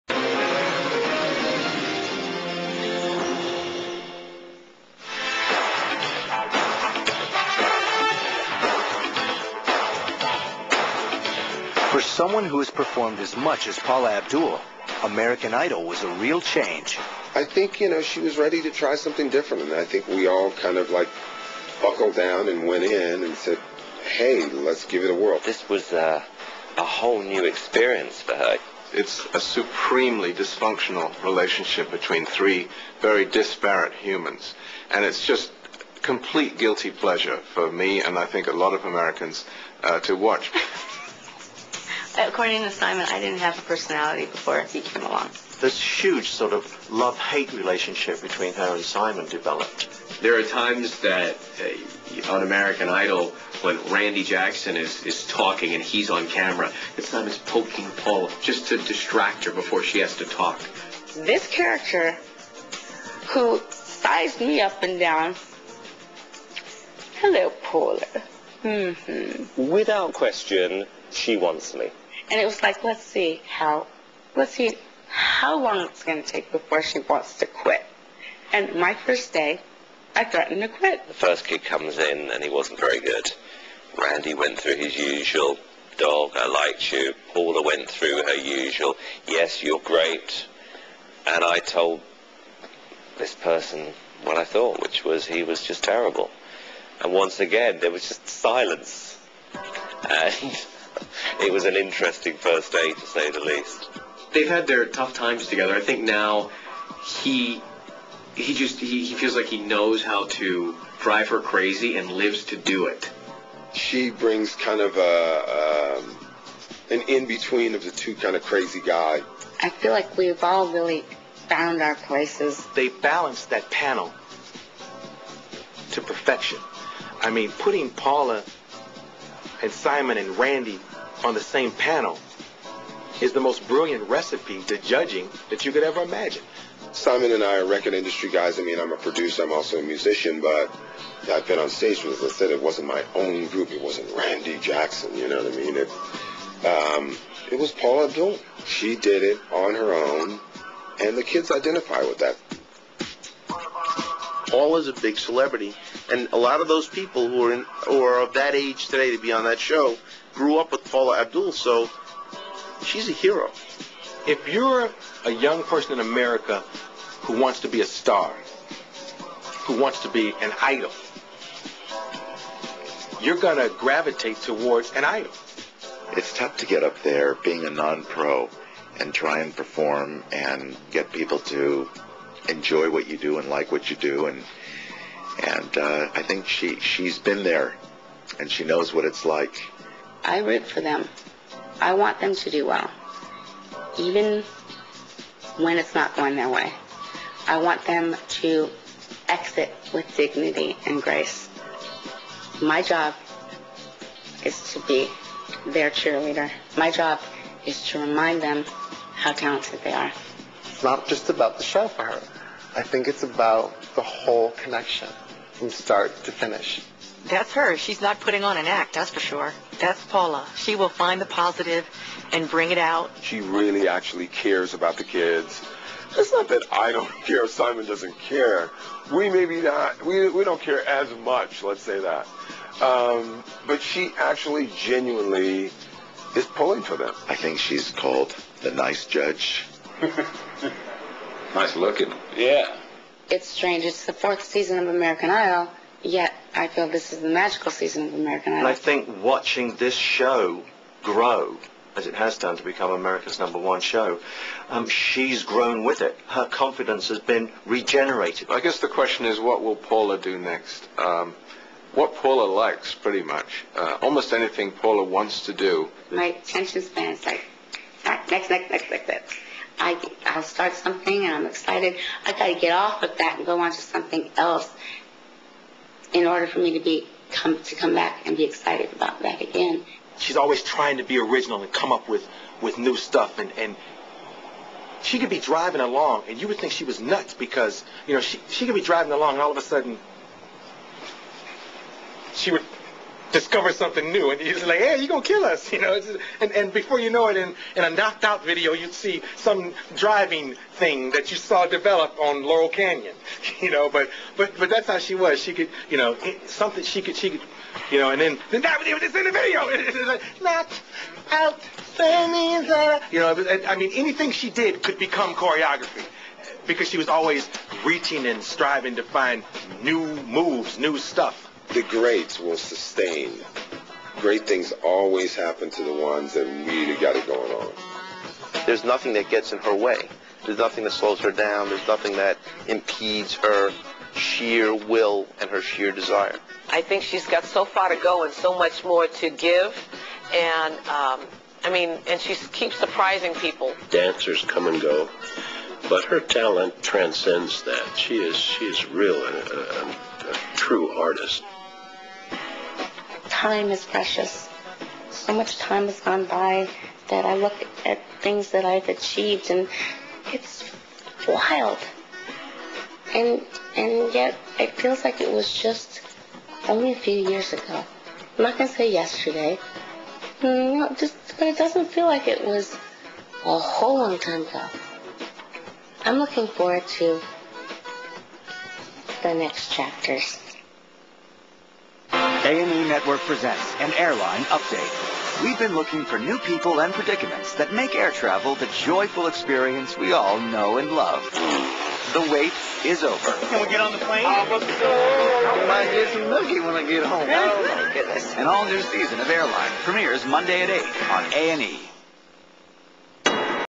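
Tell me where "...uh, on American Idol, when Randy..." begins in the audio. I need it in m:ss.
0:52.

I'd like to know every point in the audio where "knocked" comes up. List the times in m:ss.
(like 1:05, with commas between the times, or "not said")
4:57, 5:10.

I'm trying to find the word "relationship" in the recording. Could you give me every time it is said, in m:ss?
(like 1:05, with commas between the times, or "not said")
0:31, 0:47.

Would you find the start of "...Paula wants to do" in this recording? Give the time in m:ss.
4:24.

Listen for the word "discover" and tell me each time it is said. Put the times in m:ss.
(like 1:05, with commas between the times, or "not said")
4:53.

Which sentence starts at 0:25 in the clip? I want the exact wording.
This was uh, a whole new experience for her.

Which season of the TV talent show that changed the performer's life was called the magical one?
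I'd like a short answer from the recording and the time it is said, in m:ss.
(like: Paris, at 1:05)
4th, at 4:04.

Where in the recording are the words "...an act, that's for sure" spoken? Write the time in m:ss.
3:38.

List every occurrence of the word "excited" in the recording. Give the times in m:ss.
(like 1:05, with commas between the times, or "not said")
4:31, 4:38.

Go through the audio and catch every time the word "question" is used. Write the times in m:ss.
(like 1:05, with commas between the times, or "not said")
1:10, 4:18.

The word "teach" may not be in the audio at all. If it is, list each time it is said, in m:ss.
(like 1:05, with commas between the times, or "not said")
not said.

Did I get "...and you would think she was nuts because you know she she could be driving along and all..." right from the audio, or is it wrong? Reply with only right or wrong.
right.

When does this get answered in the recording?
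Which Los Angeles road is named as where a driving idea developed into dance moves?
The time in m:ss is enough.
5:02.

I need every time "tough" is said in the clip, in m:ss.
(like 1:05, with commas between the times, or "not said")
1:44, 2:56.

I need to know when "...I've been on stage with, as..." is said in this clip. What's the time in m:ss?
2:21.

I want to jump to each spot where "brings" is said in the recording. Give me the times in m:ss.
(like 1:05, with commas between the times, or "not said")
1:54, 3:42.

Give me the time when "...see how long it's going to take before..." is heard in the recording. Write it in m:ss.
1:14.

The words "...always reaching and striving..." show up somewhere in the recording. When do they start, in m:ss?
5:17.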